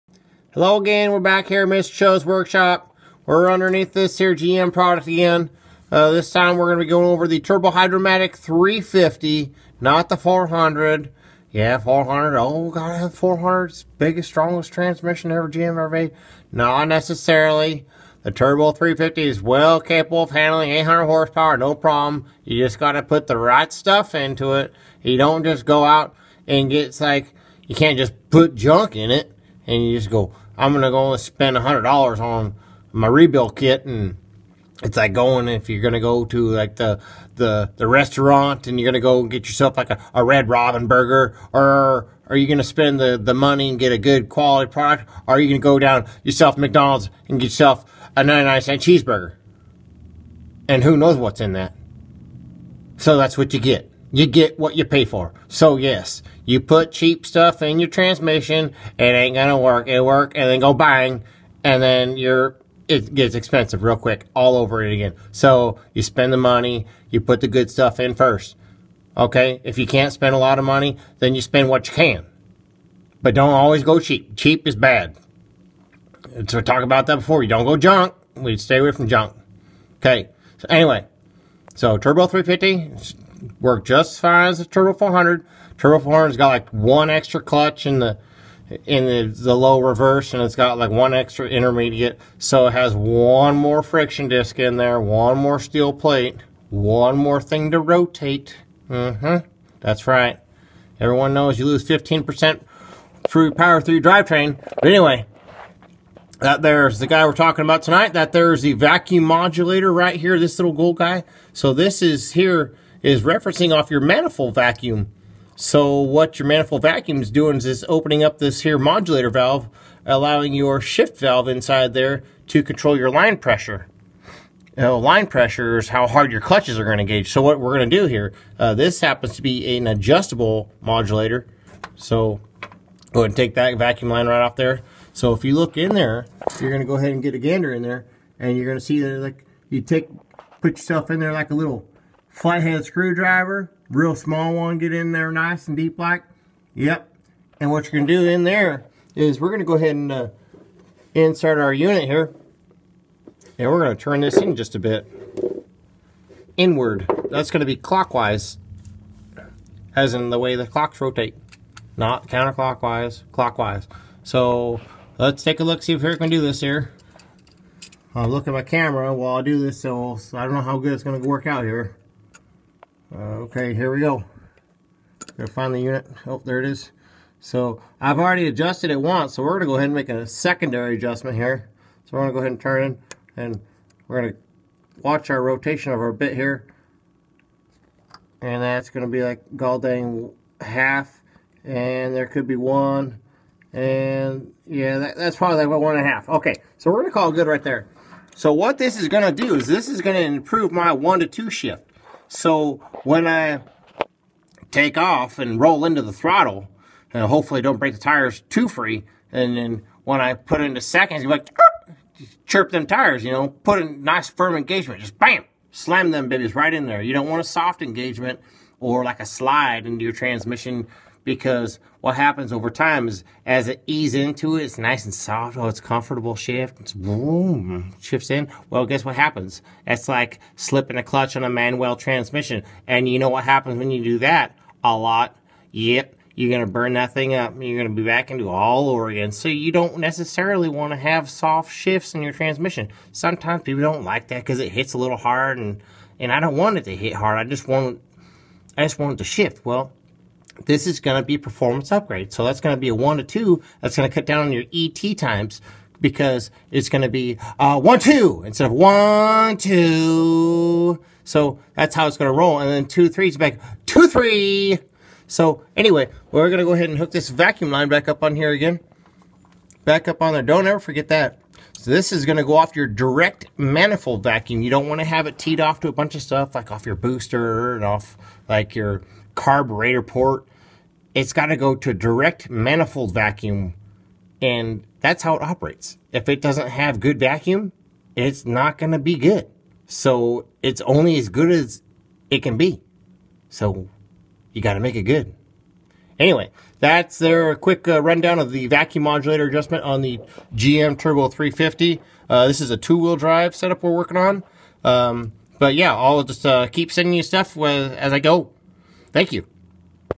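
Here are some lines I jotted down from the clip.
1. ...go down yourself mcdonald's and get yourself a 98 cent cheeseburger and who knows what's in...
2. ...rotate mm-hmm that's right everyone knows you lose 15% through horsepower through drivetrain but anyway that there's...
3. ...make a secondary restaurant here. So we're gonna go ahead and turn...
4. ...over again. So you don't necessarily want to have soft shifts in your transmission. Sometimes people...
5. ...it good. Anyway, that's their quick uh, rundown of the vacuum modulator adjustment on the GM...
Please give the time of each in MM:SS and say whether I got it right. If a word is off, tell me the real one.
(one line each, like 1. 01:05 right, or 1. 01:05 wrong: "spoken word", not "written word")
1. 00:45 wrong: "99", not "98"
2. 01:37 wrong: "power", not "horsepower"
3. 02:59 wrong: "adjustment", not "restaurant"
4. 03:58 right
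5. 04:54 right.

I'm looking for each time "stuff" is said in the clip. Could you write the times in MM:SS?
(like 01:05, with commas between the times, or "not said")
00:23, 00:57, 01:07, 04:36, 05:07.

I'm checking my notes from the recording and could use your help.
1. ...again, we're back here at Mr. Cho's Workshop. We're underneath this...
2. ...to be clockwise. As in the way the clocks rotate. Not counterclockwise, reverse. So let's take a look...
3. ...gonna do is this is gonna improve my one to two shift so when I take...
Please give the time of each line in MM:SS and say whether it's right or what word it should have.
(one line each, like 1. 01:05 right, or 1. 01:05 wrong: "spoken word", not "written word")
1. 00:00 right
2. 02:37 wrong: "clockwise", not "reverse"
3. 03:19 right.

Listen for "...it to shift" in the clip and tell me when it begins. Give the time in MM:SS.
04:09.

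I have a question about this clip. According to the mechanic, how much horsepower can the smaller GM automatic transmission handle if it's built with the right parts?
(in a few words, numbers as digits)
800.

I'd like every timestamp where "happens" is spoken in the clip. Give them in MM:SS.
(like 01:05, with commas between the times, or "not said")
02:09, 03:42, 03:49, 03:53.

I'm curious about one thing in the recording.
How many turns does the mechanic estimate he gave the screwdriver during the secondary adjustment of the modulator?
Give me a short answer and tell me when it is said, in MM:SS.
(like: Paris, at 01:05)
1.5, at 03:15.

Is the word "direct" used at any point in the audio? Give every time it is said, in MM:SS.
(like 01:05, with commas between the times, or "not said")
04:32, 04:41.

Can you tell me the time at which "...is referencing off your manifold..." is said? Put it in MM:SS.
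01:53.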